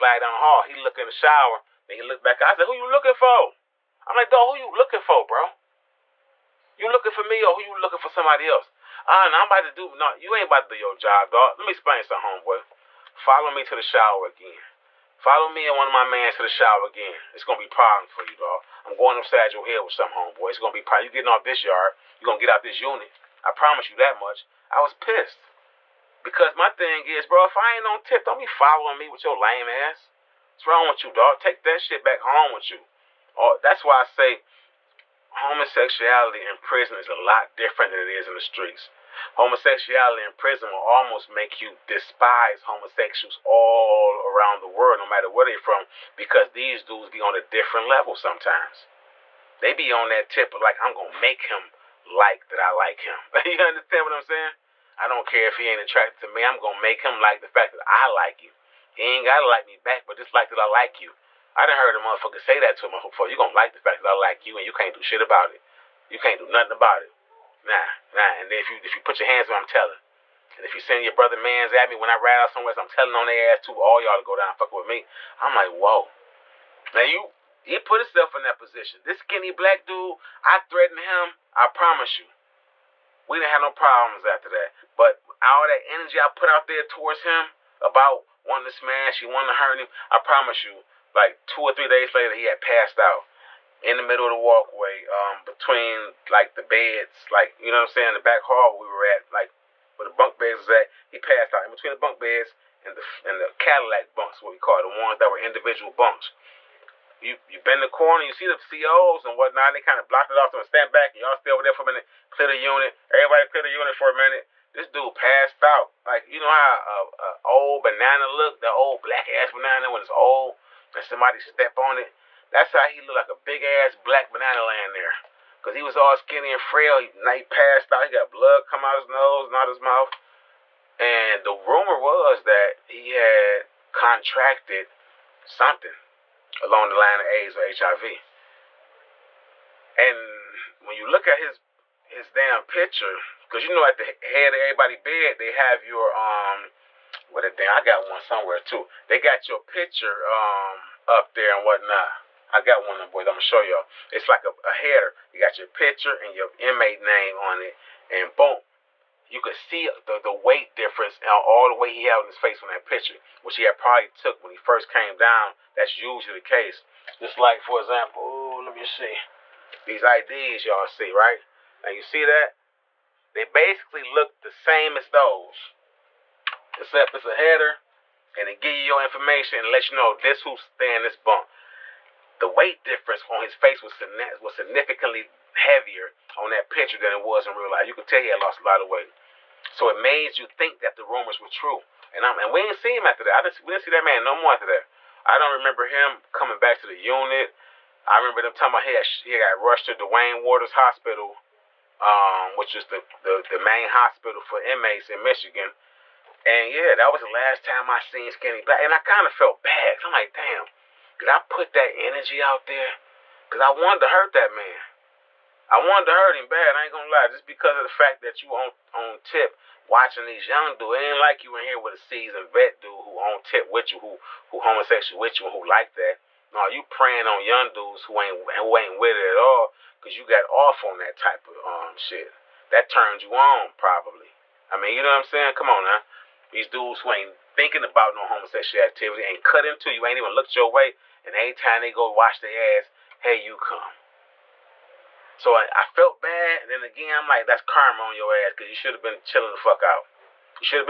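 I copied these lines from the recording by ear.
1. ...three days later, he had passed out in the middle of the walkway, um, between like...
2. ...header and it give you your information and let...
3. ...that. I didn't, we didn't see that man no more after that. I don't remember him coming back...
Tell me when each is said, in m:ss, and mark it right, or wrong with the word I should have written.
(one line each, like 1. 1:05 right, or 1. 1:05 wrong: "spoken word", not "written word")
1. 1:31 right
2. 2:57 right
3. 3:13 right.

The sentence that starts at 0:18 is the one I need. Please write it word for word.
I'm going upside your head with some homeboy.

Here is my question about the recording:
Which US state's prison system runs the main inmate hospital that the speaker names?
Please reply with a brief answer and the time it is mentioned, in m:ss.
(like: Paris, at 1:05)
Michigan, at 3:25.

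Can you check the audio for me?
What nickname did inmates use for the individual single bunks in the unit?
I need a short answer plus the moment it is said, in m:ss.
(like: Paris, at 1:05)
Cadillac bunks, at 1:43.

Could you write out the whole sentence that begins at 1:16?
Now you he put himself in that position.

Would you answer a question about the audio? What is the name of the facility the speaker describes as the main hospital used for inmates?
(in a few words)
Duane Waters Hospital.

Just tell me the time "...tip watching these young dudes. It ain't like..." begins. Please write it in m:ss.
3:39.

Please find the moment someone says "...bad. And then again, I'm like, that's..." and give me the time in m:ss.
4:06.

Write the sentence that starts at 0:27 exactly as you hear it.
If I ain't on tip, don't be following me with your lame ass.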